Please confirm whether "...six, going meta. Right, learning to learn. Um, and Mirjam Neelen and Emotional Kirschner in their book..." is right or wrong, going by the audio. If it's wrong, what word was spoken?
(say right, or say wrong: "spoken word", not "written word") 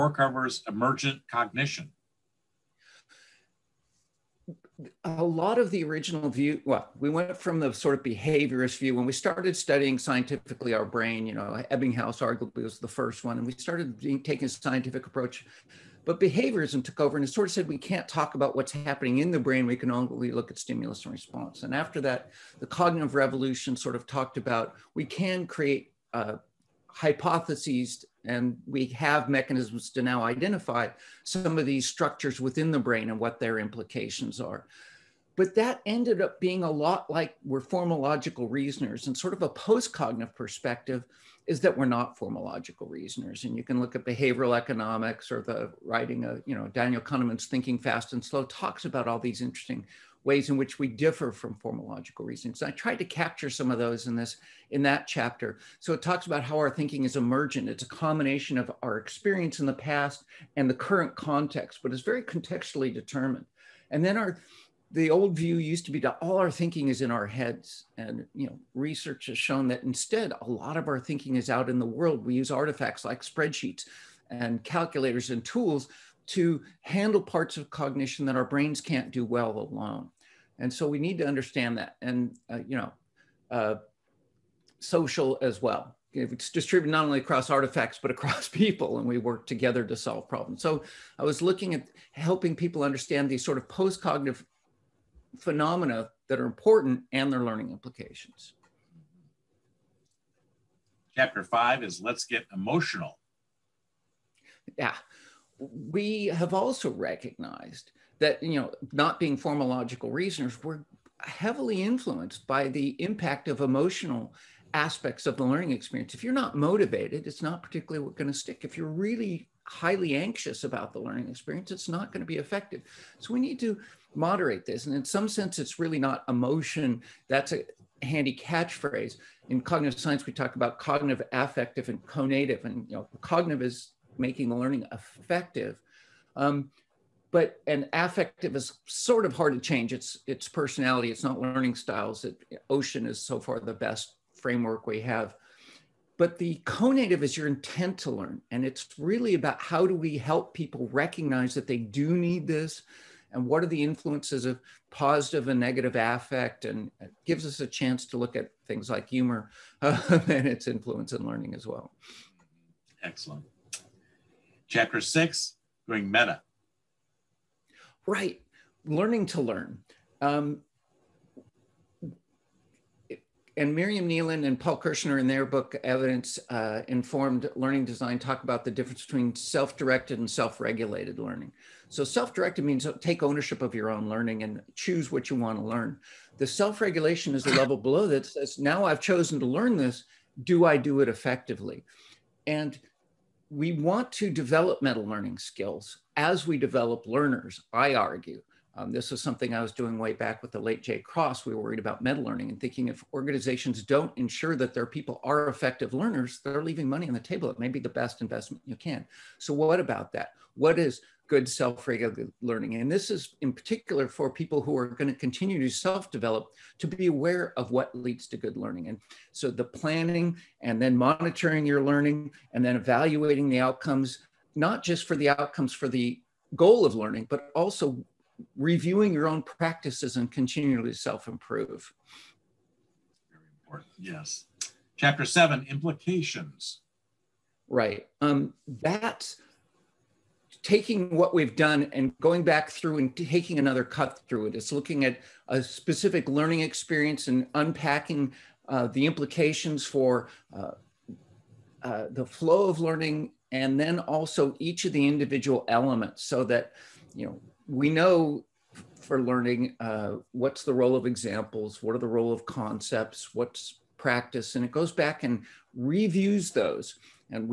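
wrong: "Paul", not "Emotional".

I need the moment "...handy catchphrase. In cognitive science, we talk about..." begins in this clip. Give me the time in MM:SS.
02:08.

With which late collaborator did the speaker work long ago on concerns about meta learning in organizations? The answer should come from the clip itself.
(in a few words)
Jay Cross.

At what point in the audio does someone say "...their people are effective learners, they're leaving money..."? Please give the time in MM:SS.
03:24.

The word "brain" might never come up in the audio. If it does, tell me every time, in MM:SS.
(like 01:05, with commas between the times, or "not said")
00:10, 00:19, 00:32, 01:18.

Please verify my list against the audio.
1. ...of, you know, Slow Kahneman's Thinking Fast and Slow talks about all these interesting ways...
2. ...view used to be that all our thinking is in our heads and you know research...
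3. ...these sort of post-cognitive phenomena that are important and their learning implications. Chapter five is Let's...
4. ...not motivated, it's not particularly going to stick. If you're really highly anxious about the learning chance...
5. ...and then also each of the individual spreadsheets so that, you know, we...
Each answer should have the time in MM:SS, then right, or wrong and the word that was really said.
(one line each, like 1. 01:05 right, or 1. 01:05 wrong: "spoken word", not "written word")
1. 00:46 wrong: "Daniel", not "Slow"
2. 01:05 right
3. 01:33 right
4. 01:56 wrong: "experience", not "chance"
5. 04:13 wrong: "elements", not "spreadsheets".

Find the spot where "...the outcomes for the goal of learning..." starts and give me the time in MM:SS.
03:45.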